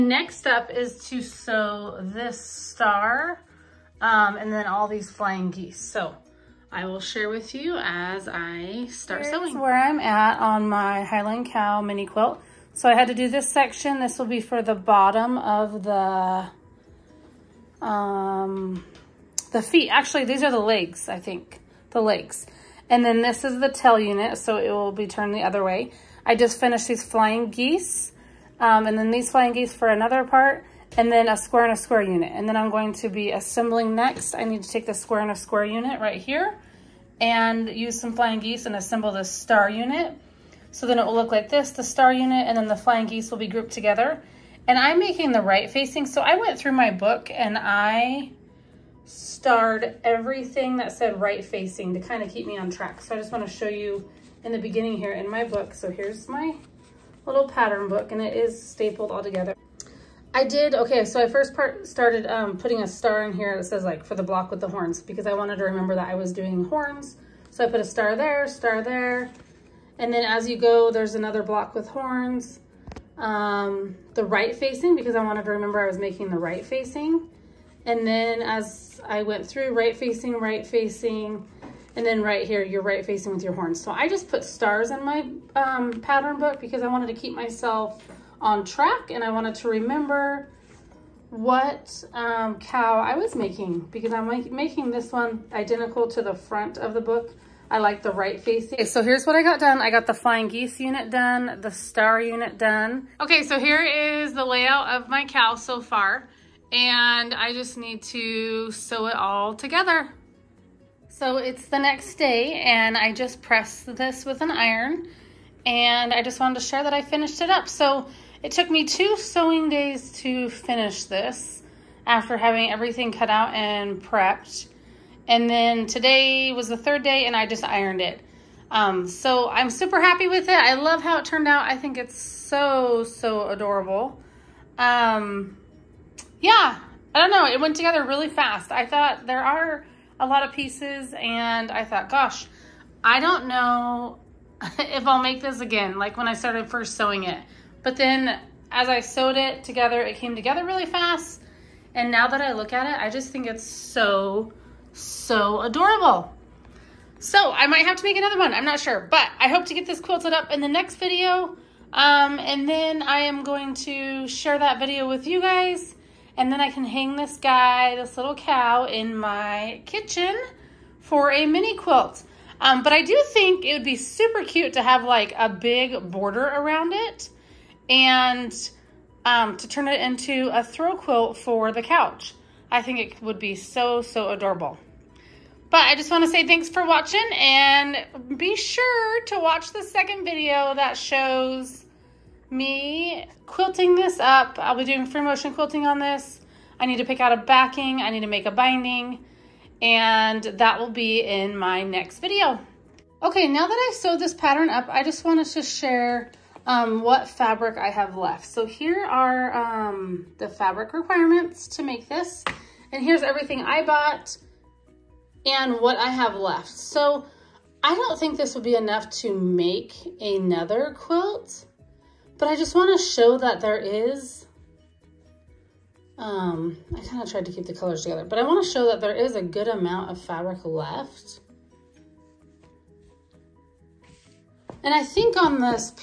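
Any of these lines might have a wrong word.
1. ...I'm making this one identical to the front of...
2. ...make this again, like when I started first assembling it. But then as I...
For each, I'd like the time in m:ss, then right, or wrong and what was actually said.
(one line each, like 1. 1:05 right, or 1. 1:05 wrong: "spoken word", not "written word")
1. 1:34 right
2. 2:25 wrong: "sewing", not "assembling".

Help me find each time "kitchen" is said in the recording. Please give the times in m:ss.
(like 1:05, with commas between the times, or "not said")
2:49.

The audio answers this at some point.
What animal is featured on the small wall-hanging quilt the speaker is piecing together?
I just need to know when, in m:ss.
0:11.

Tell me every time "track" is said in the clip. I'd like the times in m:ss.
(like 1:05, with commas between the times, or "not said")
0:52, 1:28.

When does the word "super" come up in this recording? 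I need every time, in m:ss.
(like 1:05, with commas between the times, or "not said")
2:09, 2:53.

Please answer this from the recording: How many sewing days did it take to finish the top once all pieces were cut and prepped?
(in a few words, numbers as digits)
2.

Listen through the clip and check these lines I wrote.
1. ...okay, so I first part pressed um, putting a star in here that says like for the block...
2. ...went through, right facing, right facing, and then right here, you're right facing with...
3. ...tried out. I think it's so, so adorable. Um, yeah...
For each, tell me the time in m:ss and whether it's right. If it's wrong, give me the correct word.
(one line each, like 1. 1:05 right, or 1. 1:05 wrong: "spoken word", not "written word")
1. 1:00 wrong: "started", not "pressed"
2. 1:19 right
3. 2:11 wrong: "turned", not "tried".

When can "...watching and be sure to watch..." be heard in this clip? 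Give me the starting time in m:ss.
3:06.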